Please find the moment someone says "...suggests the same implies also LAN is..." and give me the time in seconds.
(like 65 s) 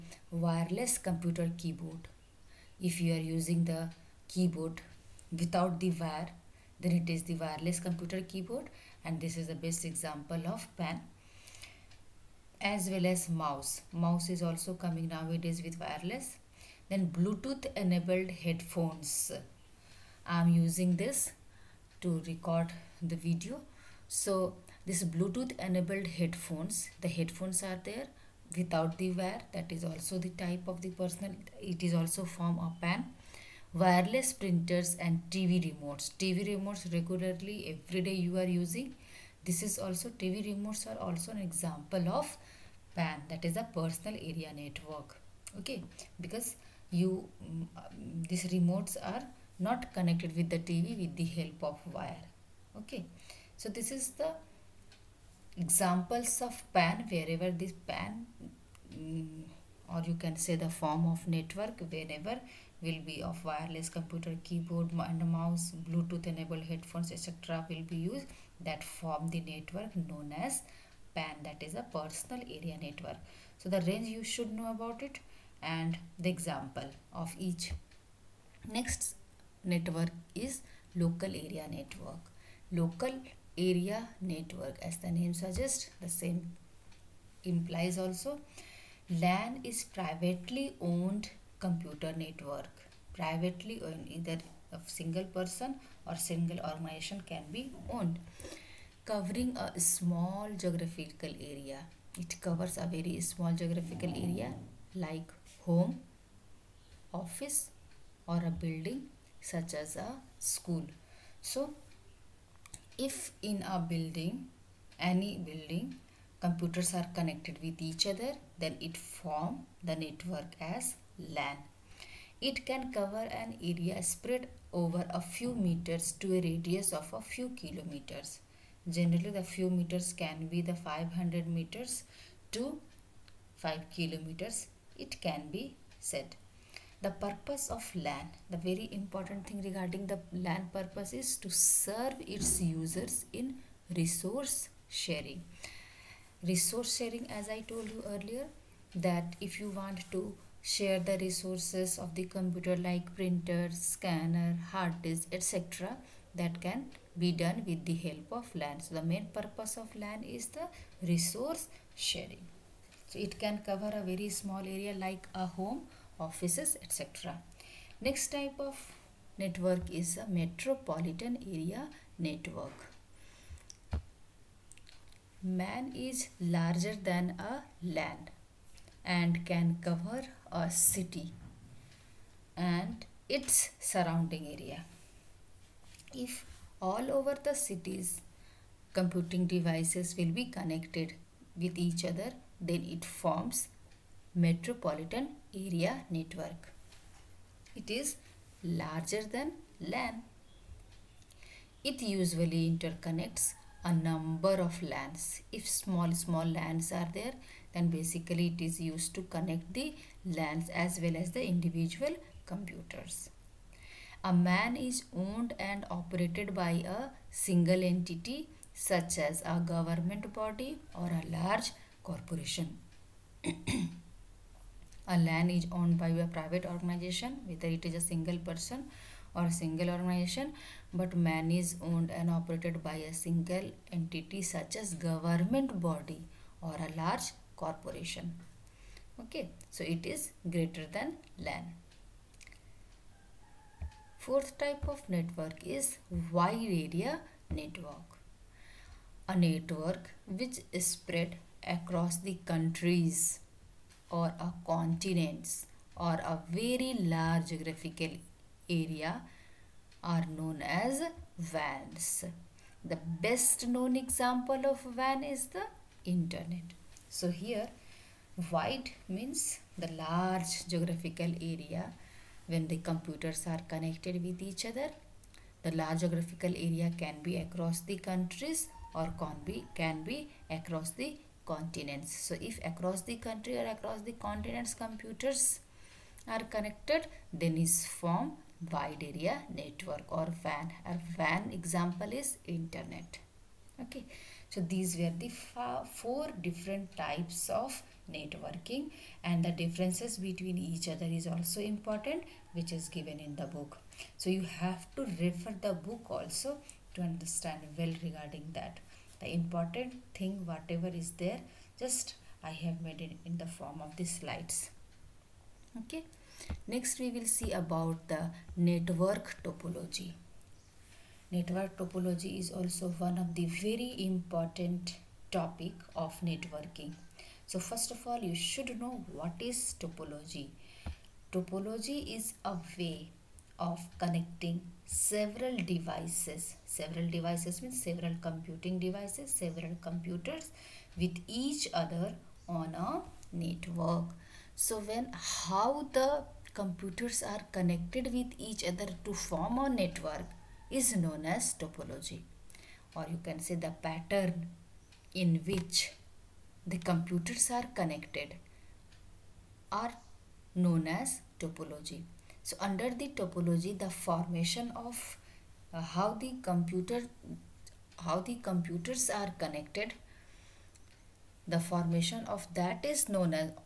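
85 s.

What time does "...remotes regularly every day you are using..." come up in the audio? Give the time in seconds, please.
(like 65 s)
36 s.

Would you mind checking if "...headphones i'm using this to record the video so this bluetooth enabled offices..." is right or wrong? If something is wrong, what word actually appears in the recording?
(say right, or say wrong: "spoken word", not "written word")
wrong: "headphones", not "offices".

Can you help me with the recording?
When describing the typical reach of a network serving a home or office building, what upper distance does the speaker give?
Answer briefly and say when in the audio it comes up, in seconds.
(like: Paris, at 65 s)
5 kilometers, at 133 s.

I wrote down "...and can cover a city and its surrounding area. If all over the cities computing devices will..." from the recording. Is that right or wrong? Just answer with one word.
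right.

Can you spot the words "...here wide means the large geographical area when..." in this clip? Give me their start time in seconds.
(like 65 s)
267 s.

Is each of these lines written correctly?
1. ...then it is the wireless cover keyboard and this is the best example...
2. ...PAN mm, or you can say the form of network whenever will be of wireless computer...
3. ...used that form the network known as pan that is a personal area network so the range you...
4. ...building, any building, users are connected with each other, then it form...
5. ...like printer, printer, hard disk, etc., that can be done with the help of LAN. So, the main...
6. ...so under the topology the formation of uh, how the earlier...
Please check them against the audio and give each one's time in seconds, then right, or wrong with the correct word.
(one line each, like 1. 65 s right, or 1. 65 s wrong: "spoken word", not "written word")
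1. 6 s wrong: "computer", not "cover"
2. 57 s right
3. 67 s right
4. 113 s wrong: "computers", not "users"
5. 152 s wrong: "scanner", not "printer"
6. 362 s wrong: "computer", not "earlier".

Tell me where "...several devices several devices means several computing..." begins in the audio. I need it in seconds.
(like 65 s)
334 s.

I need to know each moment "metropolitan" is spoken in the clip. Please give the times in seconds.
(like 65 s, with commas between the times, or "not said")
170 s, 194 s.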